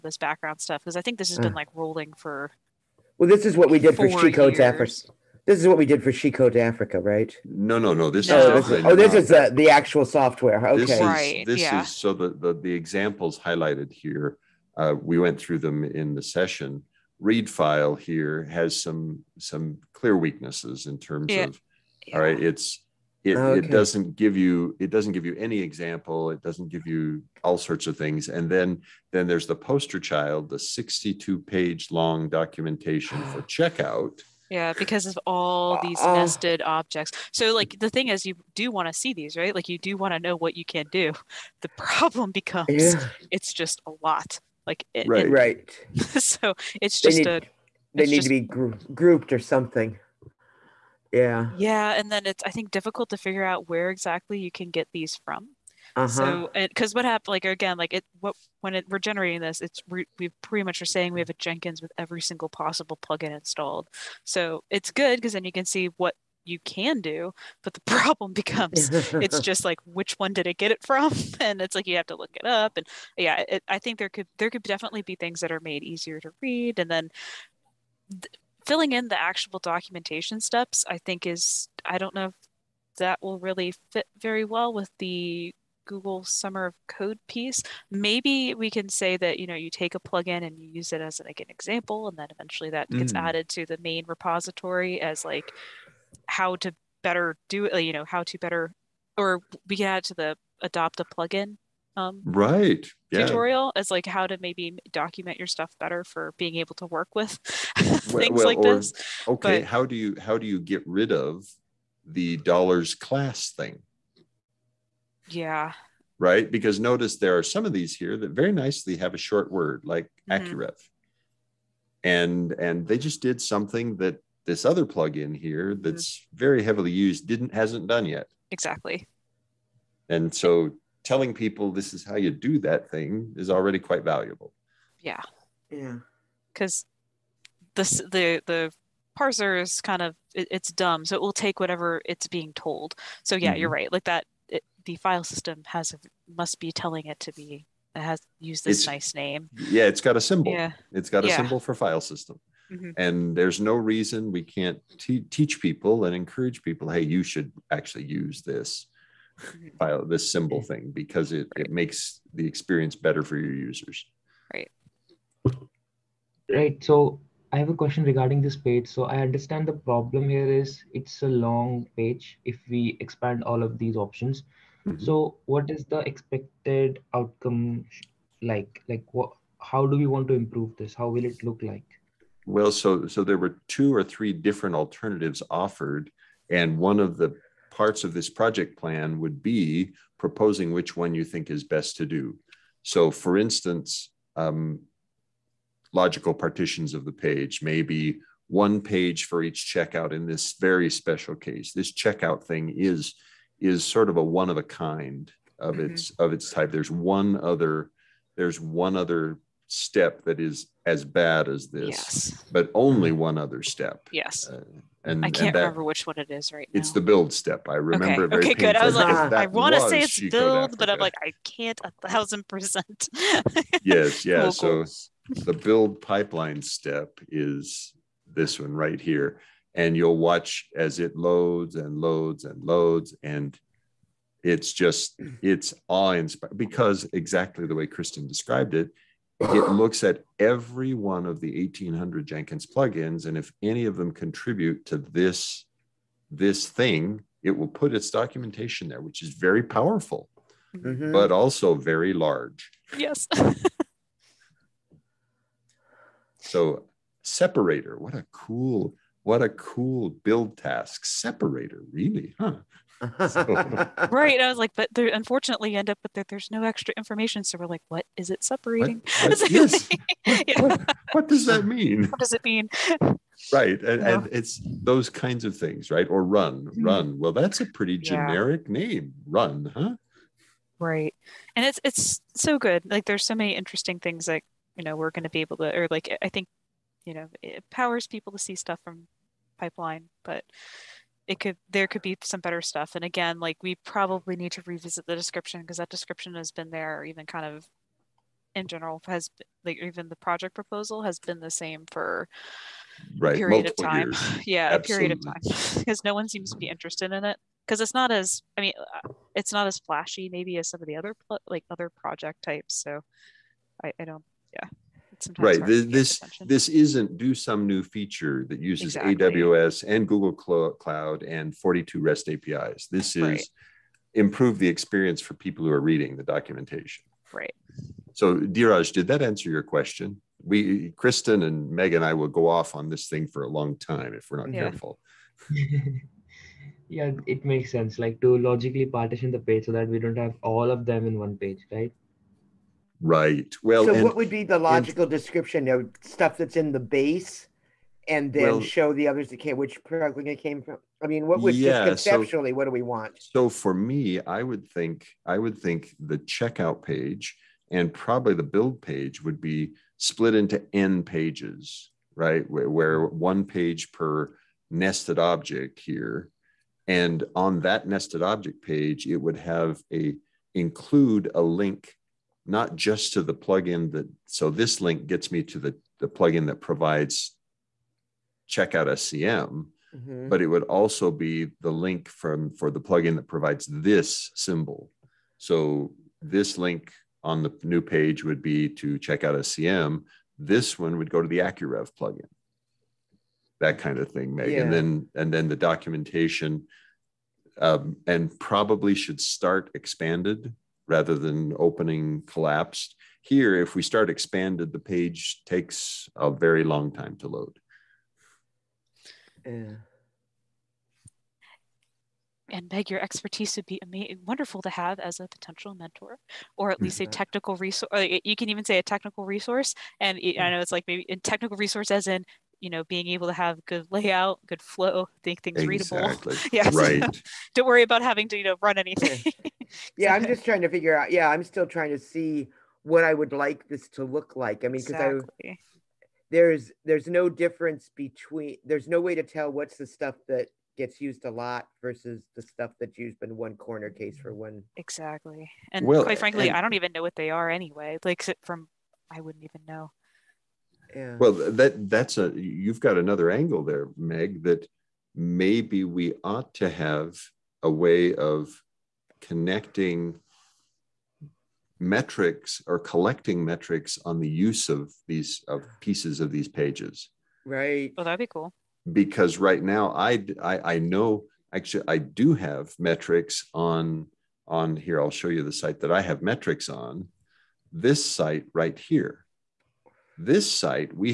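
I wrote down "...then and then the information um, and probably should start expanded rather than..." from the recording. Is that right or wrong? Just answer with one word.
wrong.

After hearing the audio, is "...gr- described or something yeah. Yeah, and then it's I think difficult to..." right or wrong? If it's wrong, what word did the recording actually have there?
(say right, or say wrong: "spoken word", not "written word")
wrong: "grouped", not "described".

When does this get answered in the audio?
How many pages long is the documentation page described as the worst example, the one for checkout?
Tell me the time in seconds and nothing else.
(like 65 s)
30 s.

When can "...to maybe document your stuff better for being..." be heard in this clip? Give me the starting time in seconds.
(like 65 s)
104 s.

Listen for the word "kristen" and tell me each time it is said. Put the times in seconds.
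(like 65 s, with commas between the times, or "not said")
237 s, 331 s.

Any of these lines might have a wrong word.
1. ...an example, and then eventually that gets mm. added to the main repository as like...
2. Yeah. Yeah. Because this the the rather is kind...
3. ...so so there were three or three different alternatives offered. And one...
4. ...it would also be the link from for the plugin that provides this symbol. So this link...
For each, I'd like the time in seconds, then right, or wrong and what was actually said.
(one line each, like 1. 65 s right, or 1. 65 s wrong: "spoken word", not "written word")
1. 91 s right
2. 134 s wrong: "parser", not "rather"
3. 182 s wrong: "two", not "three"
4. 380 s right.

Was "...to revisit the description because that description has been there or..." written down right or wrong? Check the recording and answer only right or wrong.
right.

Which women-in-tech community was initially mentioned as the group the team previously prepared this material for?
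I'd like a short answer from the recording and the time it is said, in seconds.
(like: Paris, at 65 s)
She Code Africa, at 6 s.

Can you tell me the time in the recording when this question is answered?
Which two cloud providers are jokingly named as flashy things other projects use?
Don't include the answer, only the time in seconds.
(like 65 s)
319 s.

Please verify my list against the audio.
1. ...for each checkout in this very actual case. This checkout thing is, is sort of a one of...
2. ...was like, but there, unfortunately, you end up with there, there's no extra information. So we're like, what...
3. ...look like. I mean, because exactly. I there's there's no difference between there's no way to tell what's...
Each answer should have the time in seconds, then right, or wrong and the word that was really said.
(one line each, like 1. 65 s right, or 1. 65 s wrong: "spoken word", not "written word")
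1. 199 s wrong: "special", not "actual"
2. 264 s right
3. 434 s right.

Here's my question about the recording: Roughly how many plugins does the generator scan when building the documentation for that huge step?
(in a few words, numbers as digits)
1800.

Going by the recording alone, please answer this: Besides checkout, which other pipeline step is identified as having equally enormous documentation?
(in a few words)
The build step.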